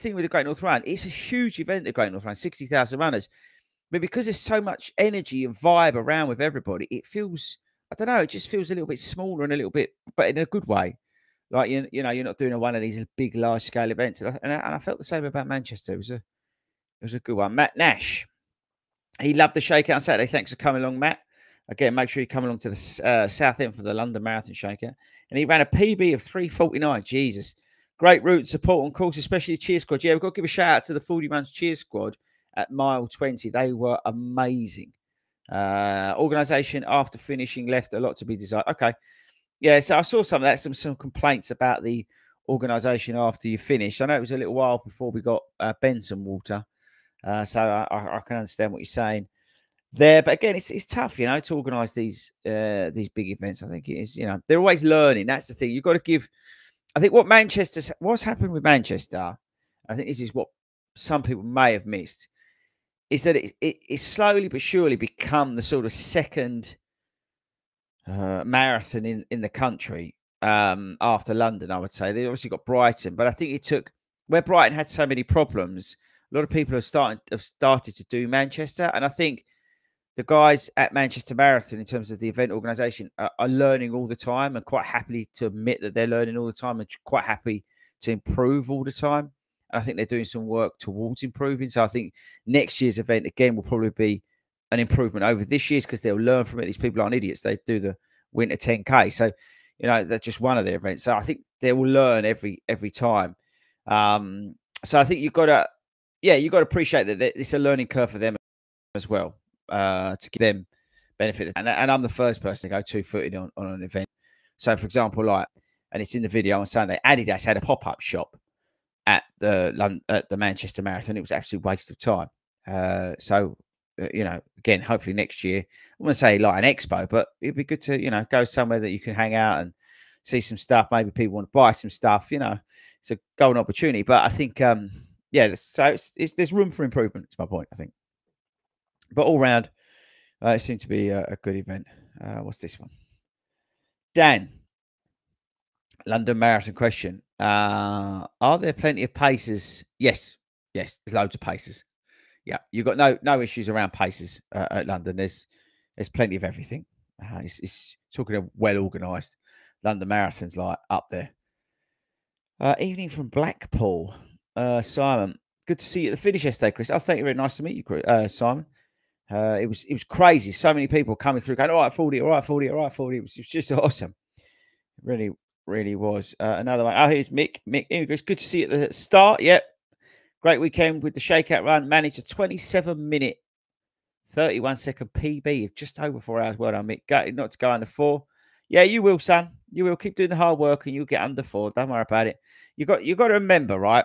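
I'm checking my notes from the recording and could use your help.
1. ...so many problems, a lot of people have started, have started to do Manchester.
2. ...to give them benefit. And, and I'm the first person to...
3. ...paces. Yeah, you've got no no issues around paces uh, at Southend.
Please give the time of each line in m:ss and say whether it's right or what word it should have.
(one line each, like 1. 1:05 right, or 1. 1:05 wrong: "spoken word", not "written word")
1. 1:14 right
2. 1:50 right
3. 2:31 wrong: "London", not "Southend".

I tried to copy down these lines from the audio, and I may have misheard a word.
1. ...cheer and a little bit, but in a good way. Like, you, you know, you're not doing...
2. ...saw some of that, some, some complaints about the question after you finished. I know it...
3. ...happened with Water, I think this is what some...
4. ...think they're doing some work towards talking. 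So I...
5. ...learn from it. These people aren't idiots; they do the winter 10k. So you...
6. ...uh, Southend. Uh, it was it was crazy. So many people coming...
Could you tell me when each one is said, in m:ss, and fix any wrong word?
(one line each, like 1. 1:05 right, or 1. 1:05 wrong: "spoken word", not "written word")
1. 0:08 wrong: "smaller", not "cheer"
2. 0:40 wrong: "organization", not "question"
3. 0:58 wrong: "Manchester", not "Water"
4. 1:29 wrong: "improving", not "talking"
5. 1:36 right
6. 2:48 wrong: "Simon", not "Southend".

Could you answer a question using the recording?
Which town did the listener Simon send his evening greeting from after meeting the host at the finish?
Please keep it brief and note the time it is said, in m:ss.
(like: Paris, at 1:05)
Blackpool, at 2:43.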